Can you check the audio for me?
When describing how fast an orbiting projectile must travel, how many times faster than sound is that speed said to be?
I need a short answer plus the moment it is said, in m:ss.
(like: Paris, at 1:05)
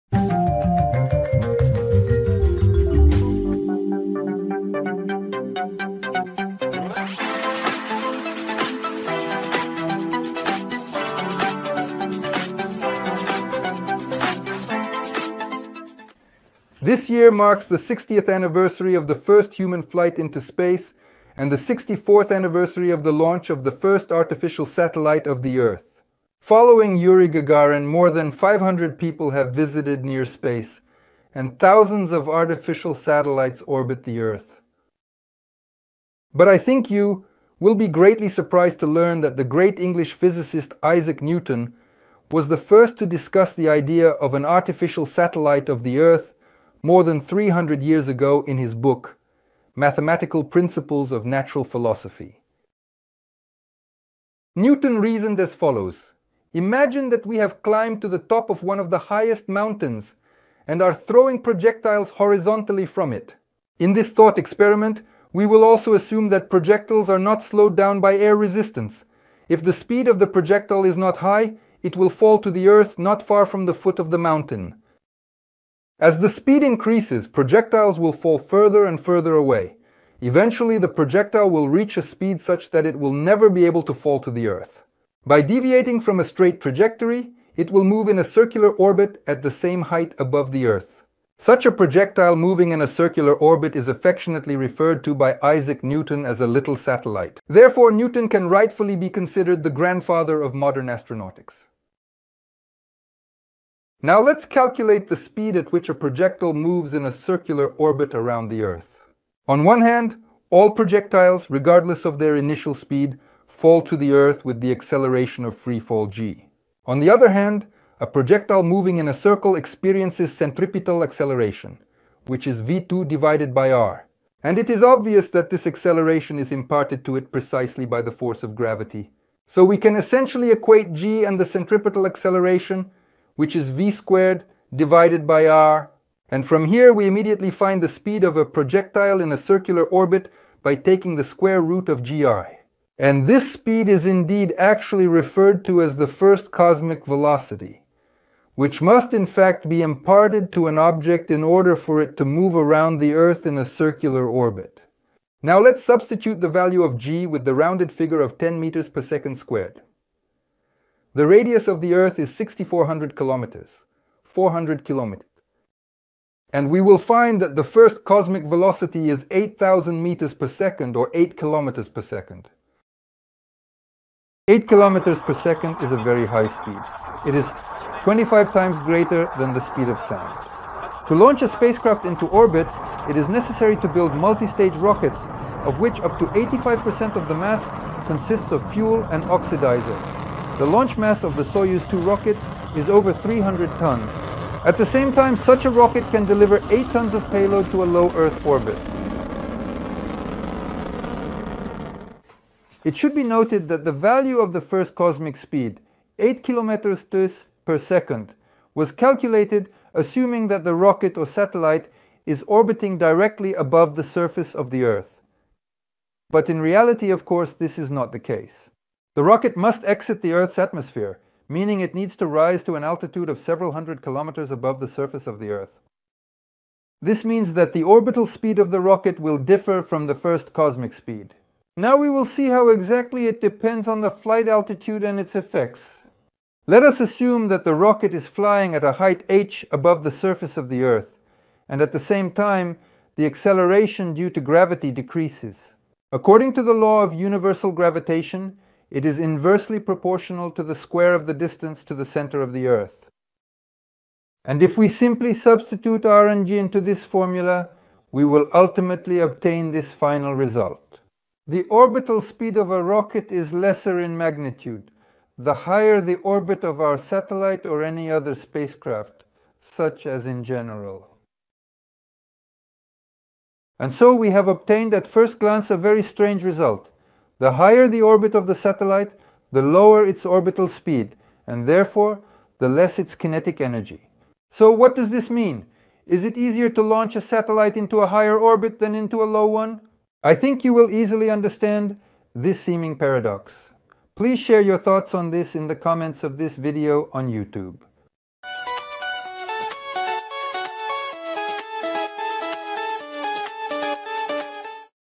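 25, at 2:58.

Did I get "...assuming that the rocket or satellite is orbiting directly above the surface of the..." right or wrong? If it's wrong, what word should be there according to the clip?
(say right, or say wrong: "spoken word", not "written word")
right.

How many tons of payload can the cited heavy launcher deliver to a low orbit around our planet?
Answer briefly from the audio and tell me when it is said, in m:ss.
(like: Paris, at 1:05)
8 tons, at 3:16.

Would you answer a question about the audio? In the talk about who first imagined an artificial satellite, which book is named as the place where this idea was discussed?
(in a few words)
Mathematical Principles of Natural Philosophy.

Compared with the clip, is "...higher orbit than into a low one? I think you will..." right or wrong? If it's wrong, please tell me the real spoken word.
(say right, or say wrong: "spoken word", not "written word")
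right.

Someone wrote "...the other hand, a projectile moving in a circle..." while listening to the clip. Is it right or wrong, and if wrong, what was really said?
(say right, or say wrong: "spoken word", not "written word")
right.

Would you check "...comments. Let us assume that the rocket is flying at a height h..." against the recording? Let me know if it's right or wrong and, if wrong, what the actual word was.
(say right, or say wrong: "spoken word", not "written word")
wrong: "effects", not "comments".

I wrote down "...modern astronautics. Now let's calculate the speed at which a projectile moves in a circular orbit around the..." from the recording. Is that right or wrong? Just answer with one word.
right.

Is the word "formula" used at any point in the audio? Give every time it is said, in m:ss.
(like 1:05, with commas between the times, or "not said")
4:17.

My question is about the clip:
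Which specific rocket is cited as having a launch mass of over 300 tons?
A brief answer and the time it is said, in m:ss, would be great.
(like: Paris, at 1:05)
Soyuz 2, at 3:11.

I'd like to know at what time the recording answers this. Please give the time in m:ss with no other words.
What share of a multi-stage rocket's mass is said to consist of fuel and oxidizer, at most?
3:06.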